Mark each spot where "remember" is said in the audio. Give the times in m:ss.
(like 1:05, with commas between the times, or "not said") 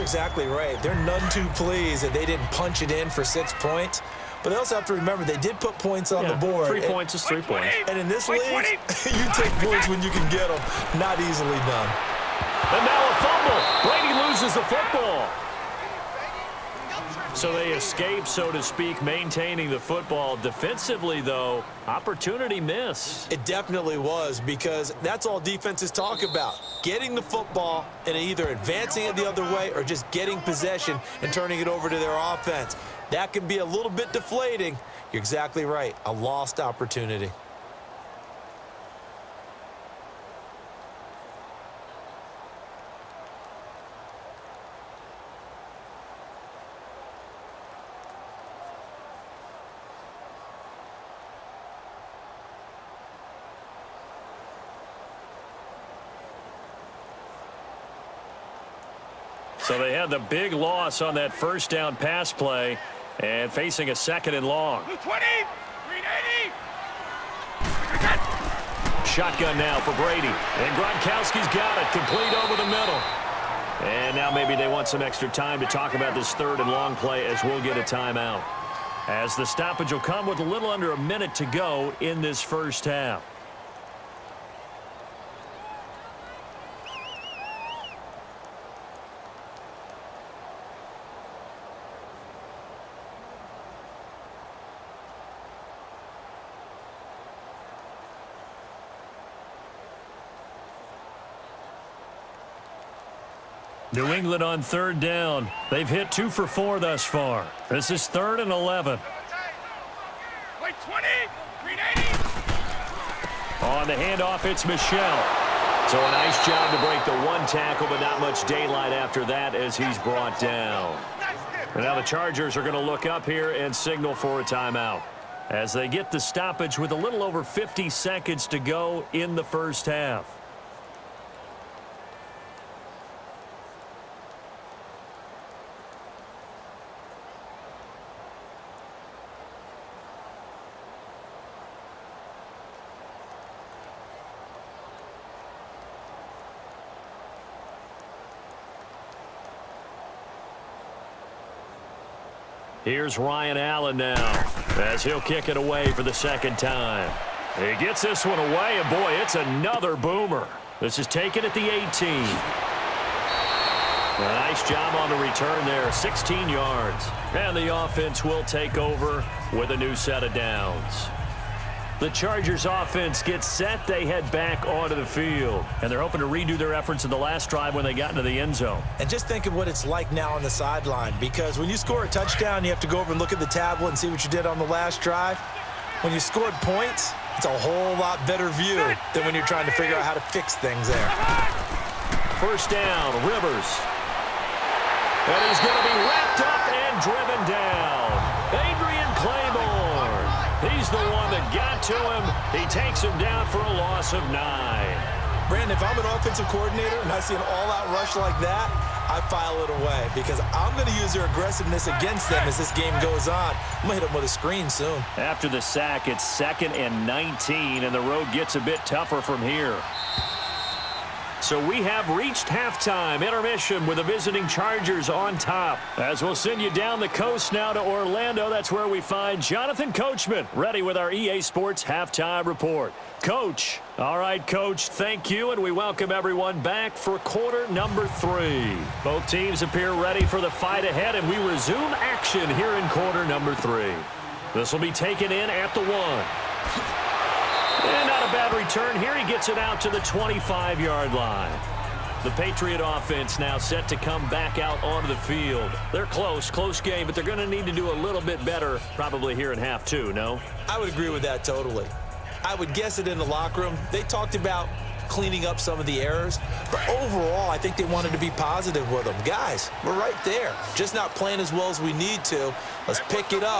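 0:04.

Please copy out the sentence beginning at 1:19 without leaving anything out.
As the stoppage will come with a little under a minute to go in this first half.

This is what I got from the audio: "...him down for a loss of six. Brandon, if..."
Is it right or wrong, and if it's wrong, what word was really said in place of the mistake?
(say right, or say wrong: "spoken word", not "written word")
wrong: "nine", not "six".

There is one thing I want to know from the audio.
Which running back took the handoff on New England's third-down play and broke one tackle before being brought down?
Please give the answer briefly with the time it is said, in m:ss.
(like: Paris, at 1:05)
Michel, at 1:54.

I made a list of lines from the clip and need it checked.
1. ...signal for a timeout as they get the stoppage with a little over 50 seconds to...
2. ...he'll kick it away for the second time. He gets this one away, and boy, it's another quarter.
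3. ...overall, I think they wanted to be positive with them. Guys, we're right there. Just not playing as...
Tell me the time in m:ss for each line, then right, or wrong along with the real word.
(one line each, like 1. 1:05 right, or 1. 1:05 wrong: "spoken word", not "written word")
1. 2:03 right
2. 2:35 wrong: "boomer", not "quarter"
3. 4:26 right.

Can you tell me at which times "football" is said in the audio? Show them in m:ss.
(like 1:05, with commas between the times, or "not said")
0:14, 0:19, 0:27.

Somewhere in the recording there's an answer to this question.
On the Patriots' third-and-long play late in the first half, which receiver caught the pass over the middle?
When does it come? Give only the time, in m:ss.
1:10.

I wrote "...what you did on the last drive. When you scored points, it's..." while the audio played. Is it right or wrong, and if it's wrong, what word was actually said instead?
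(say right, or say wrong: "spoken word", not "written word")
right.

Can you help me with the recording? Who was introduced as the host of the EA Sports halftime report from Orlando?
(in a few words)
Jonathan Coachman.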